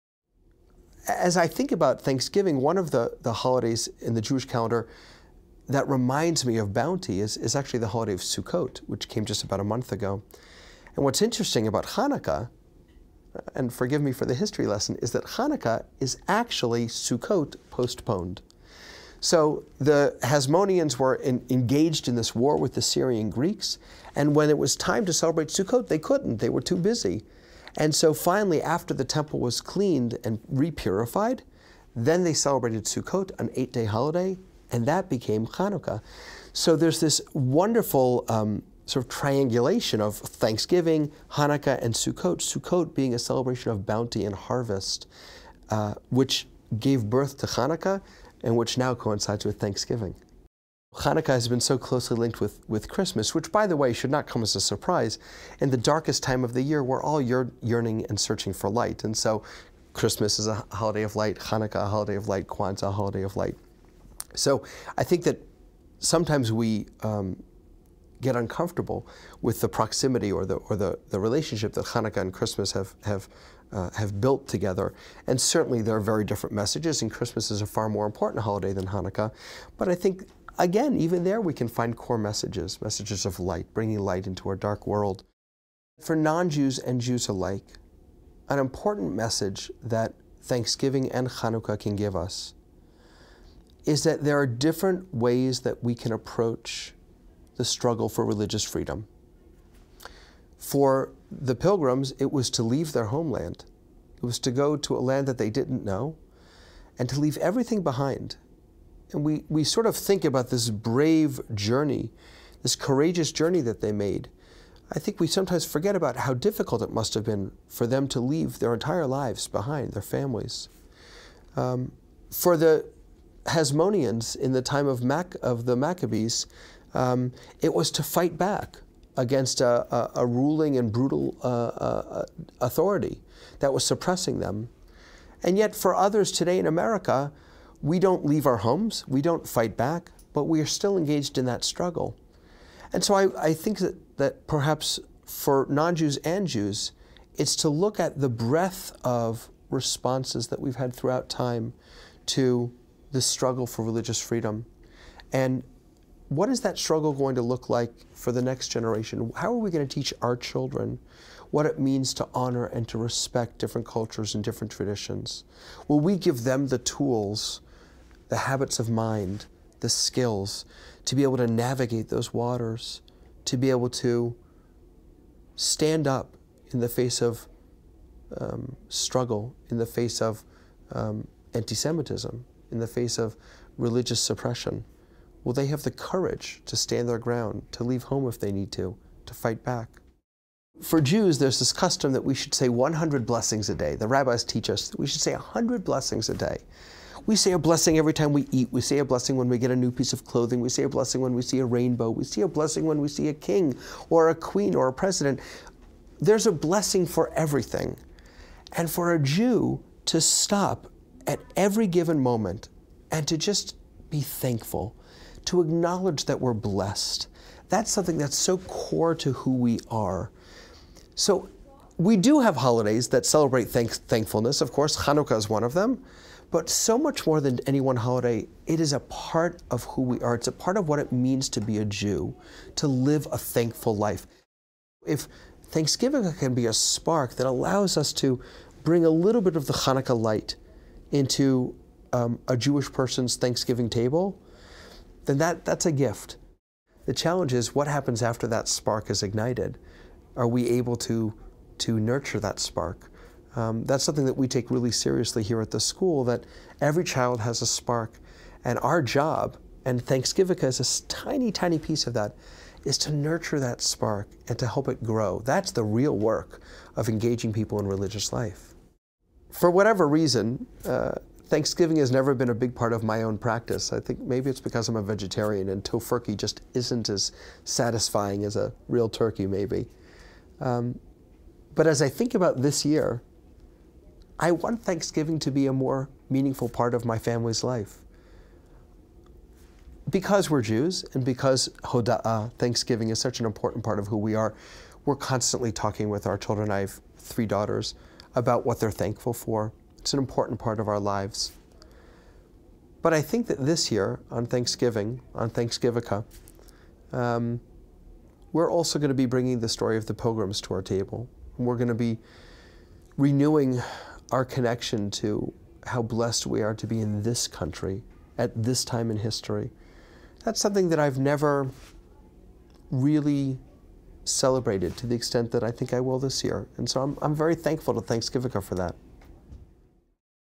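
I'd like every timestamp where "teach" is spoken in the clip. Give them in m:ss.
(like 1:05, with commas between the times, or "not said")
2:39, 3:14.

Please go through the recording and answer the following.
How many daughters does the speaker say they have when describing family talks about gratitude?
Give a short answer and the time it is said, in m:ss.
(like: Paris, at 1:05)
3, at 4:57.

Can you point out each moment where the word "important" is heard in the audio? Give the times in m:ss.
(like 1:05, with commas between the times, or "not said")
1:18, 1:28, 4:53, 5:00.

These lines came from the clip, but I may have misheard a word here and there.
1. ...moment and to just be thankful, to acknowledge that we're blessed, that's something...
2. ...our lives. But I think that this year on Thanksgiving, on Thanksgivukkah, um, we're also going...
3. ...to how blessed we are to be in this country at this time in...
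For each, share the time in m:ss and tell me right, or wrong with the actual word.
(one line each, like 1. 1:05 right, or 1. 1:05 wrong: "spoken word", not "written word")
1. 3:32 right
2. 5:00 right
3. 5:15 right.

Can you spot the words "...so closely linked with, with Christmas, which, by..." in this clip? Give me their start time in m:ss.
0:51.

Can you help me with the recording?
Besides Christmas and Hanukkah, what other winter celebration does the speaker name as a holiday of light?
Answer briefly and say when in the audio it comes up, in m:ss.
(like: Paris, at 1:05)
Kwanzaa, at 1:02.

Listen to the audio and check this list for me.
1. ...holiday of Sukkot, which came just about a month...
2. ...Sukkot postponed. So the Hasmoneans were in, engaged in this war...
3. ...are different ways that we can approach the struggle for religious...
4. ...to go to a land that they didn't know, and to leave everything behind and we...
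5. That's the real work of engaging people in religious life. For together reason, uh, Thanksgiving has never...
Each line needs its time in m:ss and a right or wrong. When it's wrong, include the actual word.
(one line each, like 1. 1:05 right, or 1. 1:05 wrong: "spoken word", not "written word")
1. 0:07 right
2. 0:16 right
3. 1:34 right
4. 1:44 right
5. 4:25 wrong: "whatever", not "together".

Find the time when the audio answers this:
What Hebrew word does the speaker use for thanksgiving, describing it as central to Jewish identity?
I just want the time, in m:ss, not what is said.
4:51.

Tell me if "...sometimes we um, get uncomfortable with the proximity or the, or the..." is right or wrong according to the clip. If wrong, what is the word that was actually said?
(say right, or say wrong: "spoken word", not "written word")
right.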